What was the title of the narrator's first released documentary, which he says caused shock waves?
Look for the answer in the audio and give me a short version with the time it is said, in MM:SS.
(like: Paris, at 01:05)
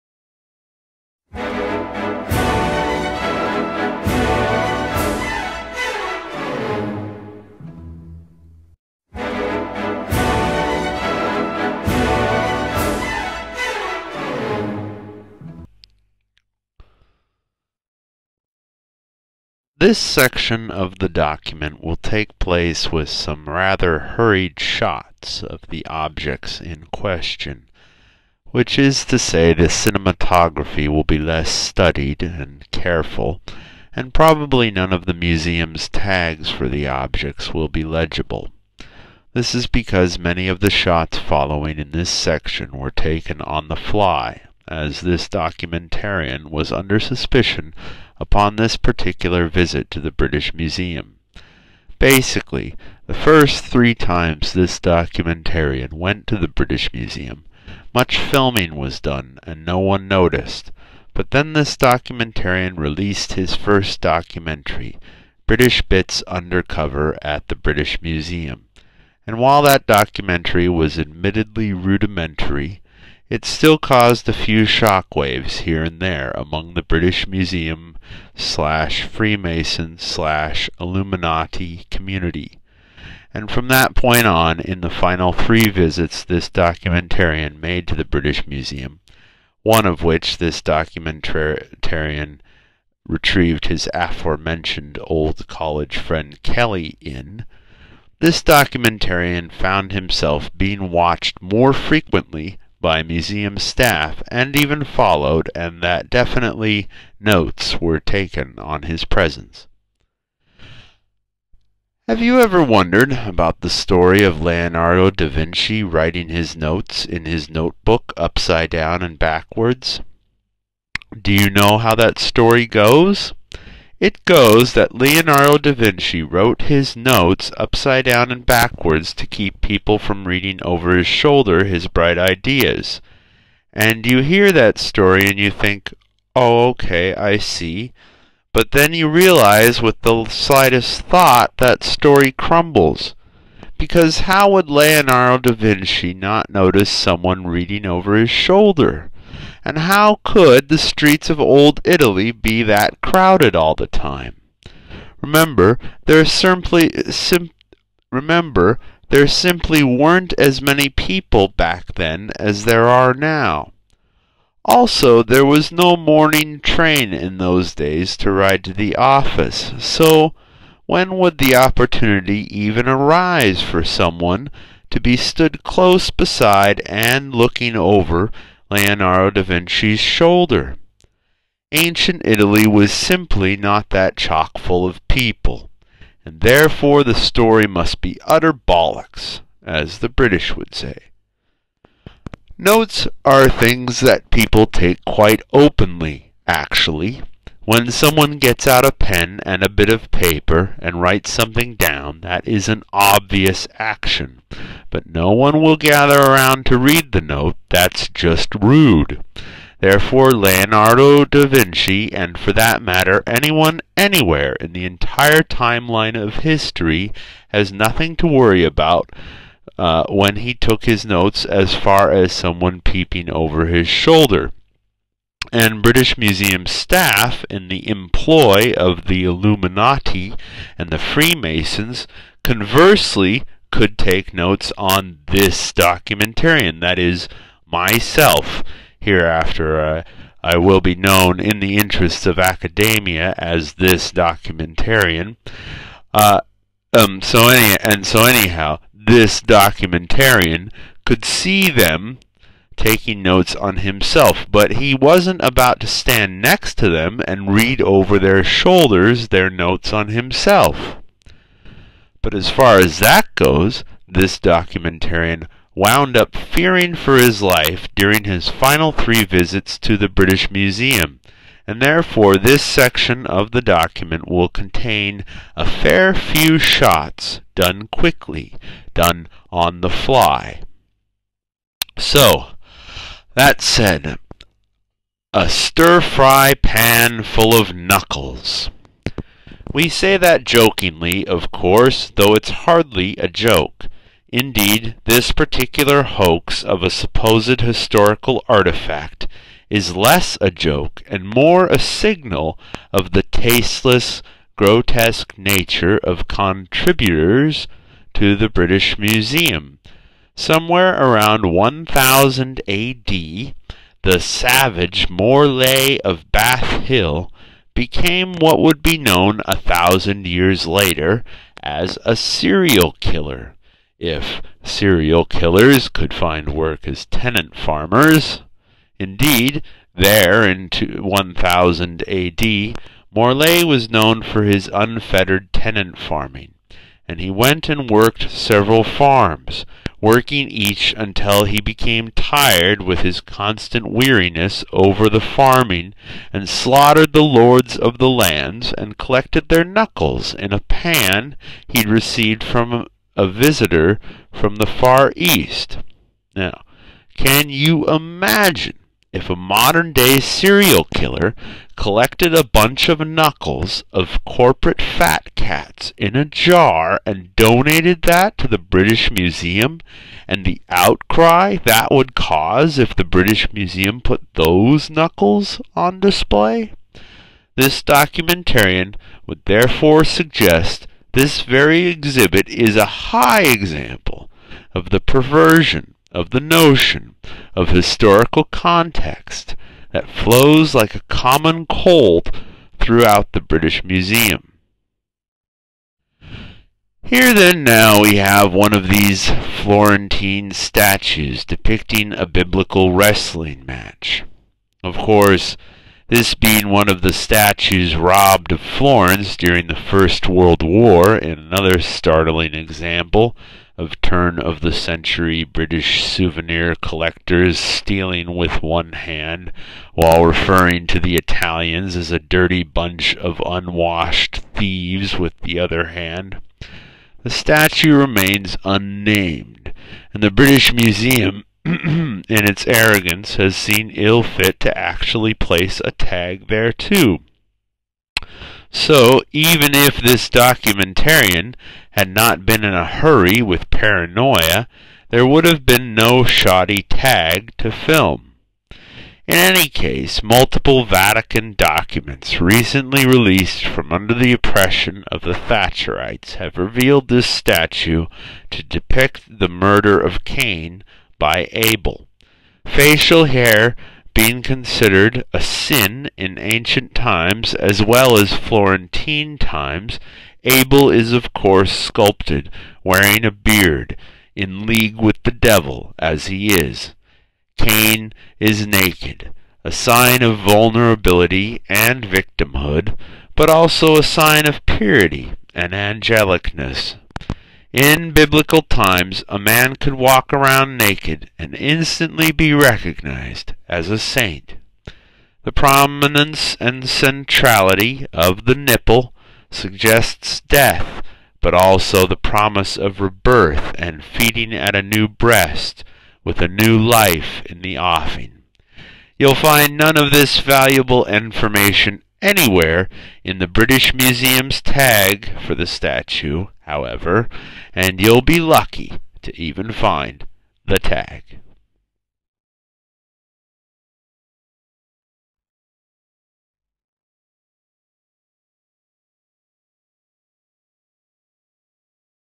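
British Bits Undercover at the British Museum, at 01:05.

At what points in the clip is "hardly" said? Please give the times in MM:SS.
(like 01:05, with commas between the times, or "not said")
04:52.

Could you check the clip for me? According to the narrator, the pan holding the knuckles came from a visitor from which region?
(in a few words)
Far East.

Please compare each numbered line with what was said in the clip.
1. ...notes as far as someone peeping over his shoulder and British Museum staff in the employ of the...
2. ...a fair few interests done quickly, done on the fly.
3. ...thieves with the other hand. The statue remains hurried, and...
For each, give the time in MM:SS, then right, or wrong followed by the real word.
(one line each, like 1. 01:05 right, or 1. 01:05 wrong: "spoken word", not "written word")
1. 03:41 right
2. 04:35 wrong: "shots", not "interests"
3. 07:04 wrong: "unnamed", not "hurried".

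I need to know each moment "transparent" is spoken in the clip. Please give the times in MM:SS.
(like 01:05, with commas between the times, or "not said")
not said.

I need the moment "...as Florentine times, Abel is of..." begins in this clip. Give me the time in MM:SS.
07:48.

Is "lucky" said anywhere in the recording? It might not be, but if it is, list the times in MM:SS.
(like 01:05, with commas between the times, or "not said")
08:38.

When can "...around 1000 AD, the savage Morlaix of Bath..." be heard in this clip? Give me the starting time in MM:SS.
05:10.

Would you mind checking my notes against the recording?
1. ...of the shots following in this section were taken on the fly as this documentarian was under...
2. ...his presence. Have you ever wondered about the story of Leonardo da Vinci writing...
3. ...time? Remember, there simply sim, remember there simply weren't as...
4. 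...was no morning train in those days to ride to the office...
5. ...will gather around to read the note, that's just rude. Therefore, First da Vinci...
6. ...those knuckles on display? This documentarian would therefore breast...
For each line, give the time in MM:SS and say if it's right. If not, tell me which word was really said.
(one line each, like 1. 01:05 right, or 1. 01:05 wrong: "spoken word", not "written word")
1. 00:40 right
2. 01:48 right
3. 02:33 right
4. 02:45 right
5. 03:25 wrong: "Leonardo", not "First"
6. 06:14 wrong: "suggest", not "breast".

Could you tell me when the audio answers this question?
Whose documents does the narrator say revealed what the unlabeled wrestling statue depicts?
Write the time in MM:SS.
07:30.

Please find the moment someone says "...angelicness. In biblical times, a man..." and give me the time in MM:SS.
08:05.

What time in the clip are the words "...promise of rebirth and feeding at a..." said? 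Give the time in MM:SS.
08:22.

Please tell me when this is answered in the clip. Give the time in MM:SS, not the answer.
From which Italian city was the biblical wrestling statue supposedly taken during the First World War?
06:48.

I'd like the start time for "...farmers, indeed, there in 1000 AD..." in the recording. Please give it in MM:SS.
05:27.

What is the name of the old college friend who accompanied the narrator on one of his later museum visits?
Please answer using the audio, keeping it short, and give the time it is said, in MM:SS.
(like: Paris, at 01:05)
Kelly, at 01:36.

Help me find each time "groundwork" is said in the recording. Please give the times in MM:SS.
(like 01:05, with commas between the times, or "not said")
not said.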